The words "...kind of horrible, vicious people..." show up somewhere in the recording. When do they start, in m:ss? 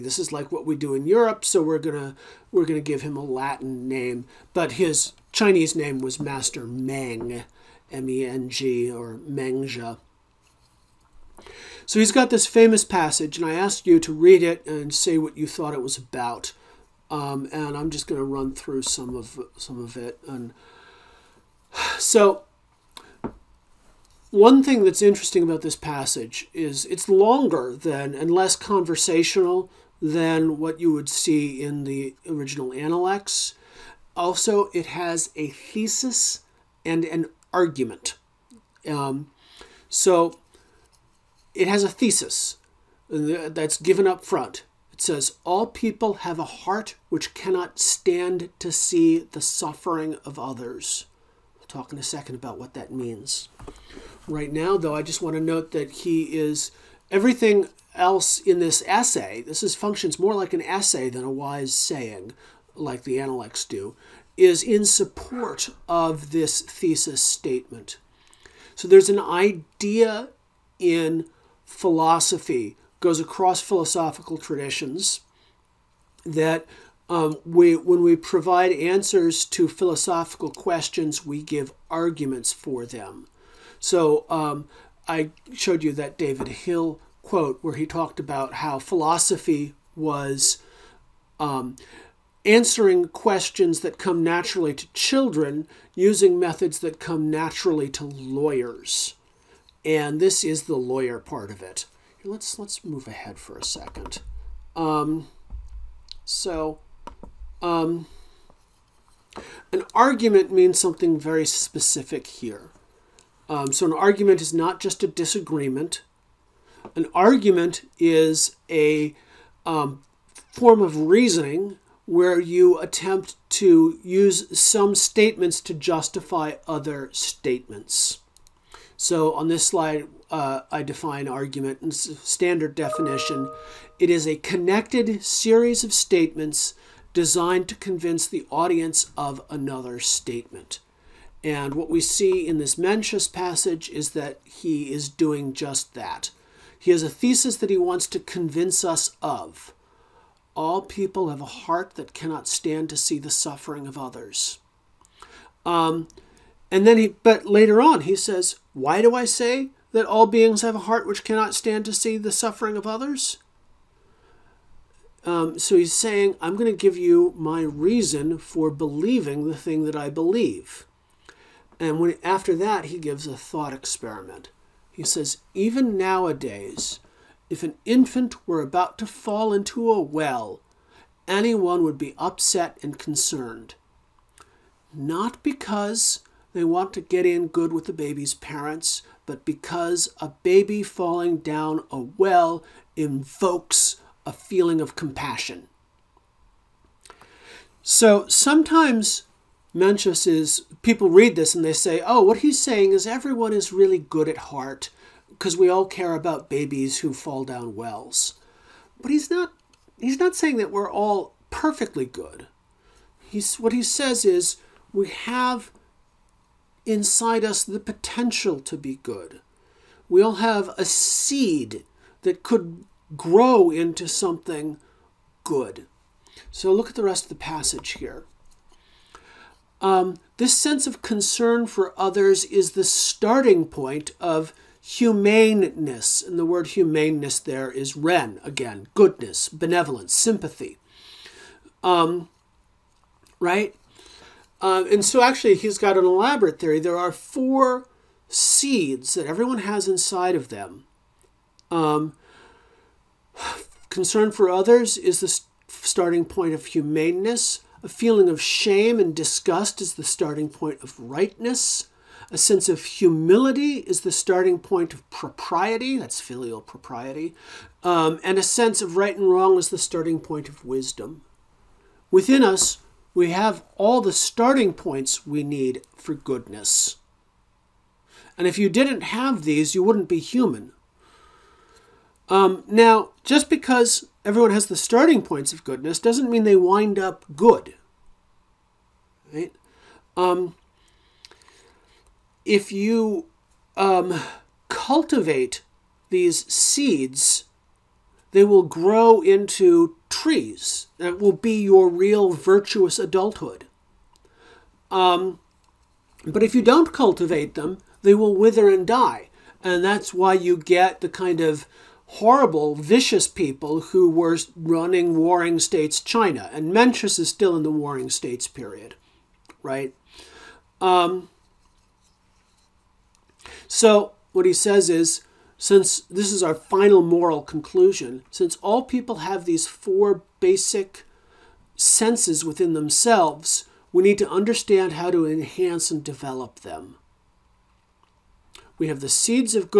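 5:11.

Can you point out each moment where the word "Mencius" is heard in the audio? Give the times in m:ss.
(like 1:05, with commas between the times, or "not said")
2:22, 3:19, 5:16.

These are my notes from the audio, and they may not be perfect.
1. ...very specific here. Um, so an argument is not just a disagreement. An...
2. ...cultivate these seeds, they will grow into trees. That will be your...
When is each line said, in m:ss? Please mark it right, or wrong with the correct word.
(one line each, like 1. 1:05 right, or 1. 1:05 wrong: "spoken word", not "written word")
1. 1:51 right
2. 4:54 right.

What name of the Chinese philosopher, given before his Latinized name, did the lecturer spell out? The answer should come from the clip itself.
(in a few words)
Master Meng.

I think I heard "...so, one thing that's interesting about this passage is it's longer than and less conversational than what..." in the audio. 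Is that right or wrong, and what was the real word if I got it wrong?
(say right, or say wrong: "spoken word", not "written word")
right.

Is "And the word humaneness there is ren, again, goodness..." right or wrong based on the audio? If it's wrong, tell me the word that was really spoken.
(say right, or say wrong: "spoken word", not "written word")
right.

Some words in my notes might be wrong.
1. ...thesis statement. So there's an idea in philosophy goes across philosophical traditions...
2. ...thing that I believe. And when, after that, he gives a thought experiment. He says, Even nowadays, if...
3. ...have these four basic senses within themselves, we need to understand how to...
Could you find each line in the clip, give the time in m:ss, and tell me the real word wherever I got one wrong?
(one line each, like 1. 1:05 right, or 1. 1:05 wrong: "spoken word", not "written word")
1. 1:06 right
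2. 2:49 right
3. 5:29 right.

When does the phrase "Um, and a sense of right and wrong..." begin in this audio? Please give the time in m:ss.
4:27.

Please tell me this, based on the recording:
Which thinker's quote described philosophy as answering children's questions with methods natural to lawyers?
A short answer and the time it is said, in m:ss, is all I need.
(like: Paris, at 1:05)
David Hill, at 1:26.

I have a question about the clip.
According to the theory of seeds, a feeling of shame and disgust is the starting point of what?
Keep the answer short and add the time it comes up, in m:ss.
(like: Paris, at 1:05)
Rightness, at 4:20.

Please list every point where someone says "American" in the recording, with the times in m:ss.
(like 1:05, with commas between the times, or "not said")
not said.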